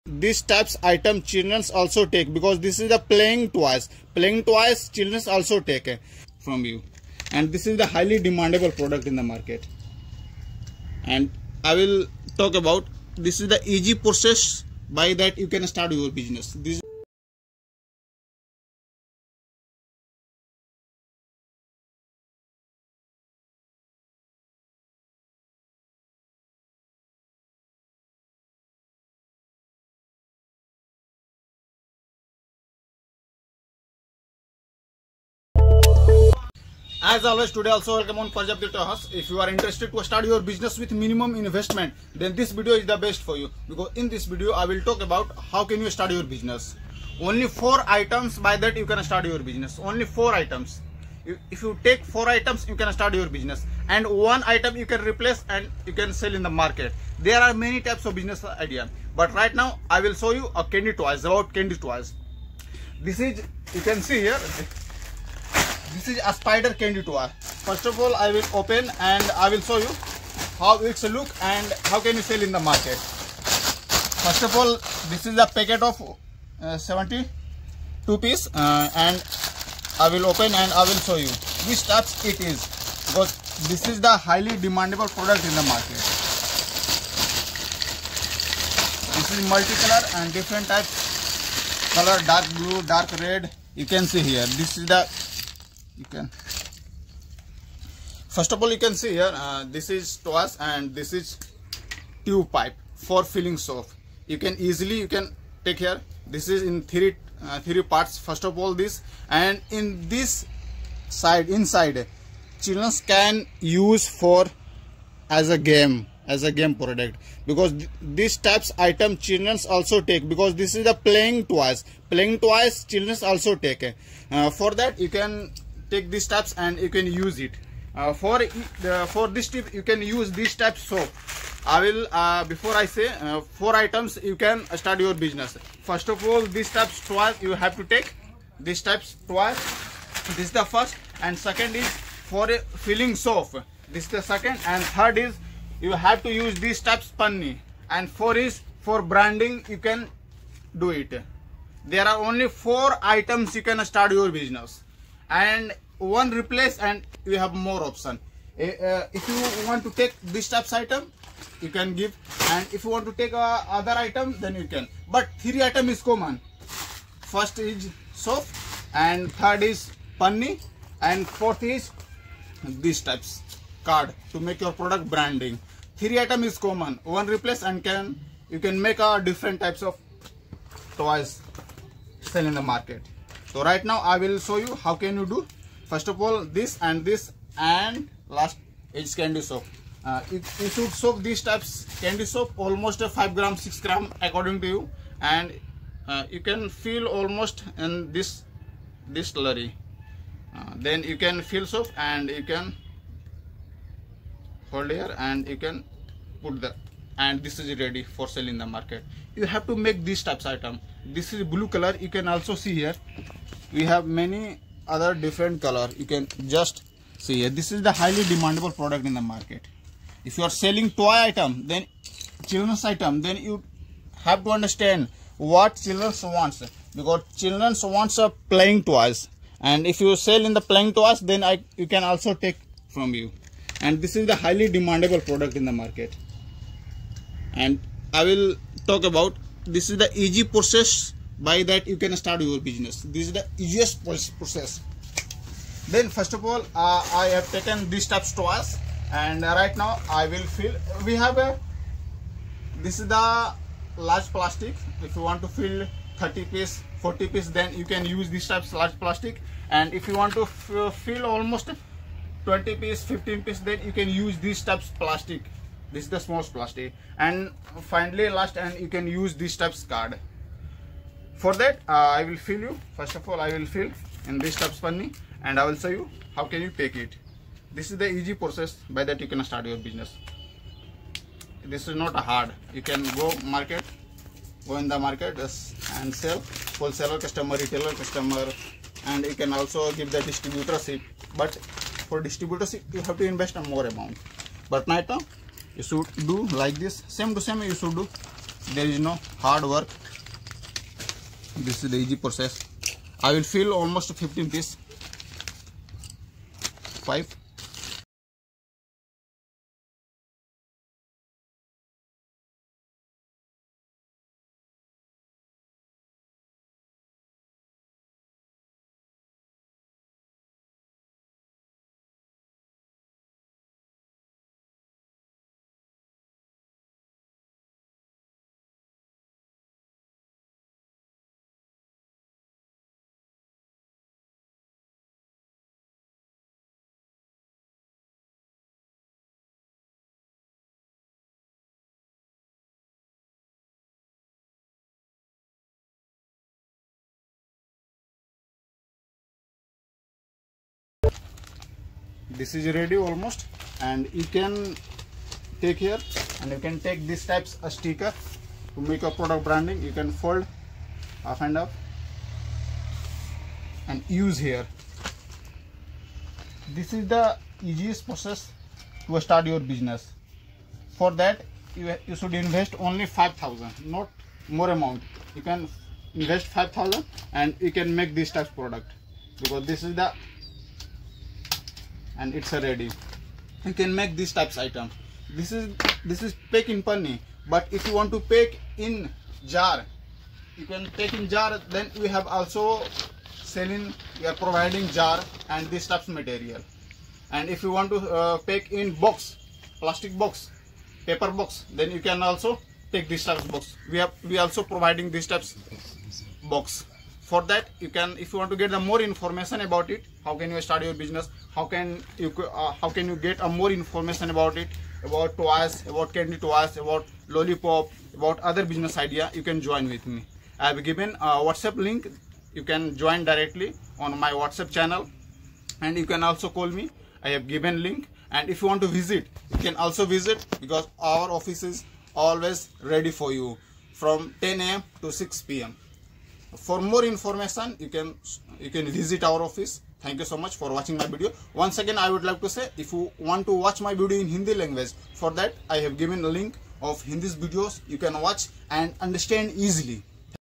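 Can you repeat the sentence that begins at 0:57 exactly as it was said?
There are many types of business idea.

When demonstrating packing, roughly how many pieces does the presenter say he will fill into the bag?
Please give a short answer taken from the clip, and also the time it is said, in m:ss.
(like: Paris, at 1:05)
15, at 5:03.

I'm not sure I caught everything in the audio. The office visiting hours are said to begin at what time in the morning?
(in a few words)
10 a.m.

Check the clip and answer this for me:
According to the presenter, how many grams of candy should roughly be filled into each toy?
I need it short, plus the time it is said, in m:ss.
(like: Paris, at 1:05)
5 to 6 grams, at 3:13.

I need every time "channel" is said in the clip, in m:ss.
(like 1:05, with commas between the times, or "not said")
7:04.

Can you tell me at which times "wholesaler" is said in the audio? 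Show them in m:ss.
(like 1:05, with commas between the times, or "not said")
4:46.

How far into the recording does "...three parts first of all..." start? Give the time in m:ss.
1:47.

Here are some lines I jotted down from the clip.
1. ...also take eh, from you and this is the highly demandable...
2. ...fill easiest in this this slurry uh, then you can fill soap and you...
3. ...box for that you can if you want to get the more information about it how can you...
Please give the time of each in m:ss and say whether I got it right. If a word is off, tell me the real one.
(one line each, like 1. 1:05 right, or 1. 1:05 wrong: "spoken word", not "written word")
1. 0:05 right
2. 3:16 wrong: "almost", not "easiest"
3. 6:46 right.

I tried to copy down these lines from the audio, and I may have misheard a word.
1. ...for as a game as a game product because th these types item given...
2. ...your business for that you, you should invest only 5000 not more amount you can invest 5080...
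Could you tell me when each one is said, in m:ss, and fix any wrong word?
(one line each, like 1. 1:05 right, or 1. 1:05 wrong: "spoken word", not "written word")
1. 1:54 wrong: "children", not "given"
2. 6:09 wrong: "5000", not "5080".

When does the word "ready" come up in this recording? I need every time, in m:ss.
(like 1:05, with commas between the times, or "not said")
3:27, 5:52, 6:22, 7:12.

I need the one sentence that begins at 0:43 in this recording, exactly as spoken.
Because in this video, I will talk about how can you start your business.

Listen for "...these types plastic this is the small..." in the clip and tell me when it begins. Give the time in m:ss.
4:24.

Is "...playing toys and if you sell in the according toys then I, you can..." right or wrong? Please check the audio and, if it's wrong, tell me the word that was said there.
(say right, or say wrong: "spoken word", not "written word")
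wrong: "playing", not "according".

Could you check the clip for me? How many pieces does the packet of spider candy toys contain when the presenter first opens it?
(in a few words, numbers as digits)
72.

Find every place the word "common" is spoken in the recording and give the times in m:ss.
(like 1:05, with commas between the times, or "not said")
2:46, 2:56.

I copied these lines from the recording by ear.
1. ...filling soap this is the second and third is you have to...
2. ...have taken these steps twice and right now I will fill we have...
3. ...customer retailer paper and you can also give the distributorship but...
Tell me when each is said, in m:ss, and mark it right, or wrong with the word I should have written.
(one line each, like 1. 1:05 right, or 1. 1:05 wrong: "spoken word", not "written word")
1. 2:22 right
2. 4:07 right
3. 4:47 wrong: "customer", not "paper".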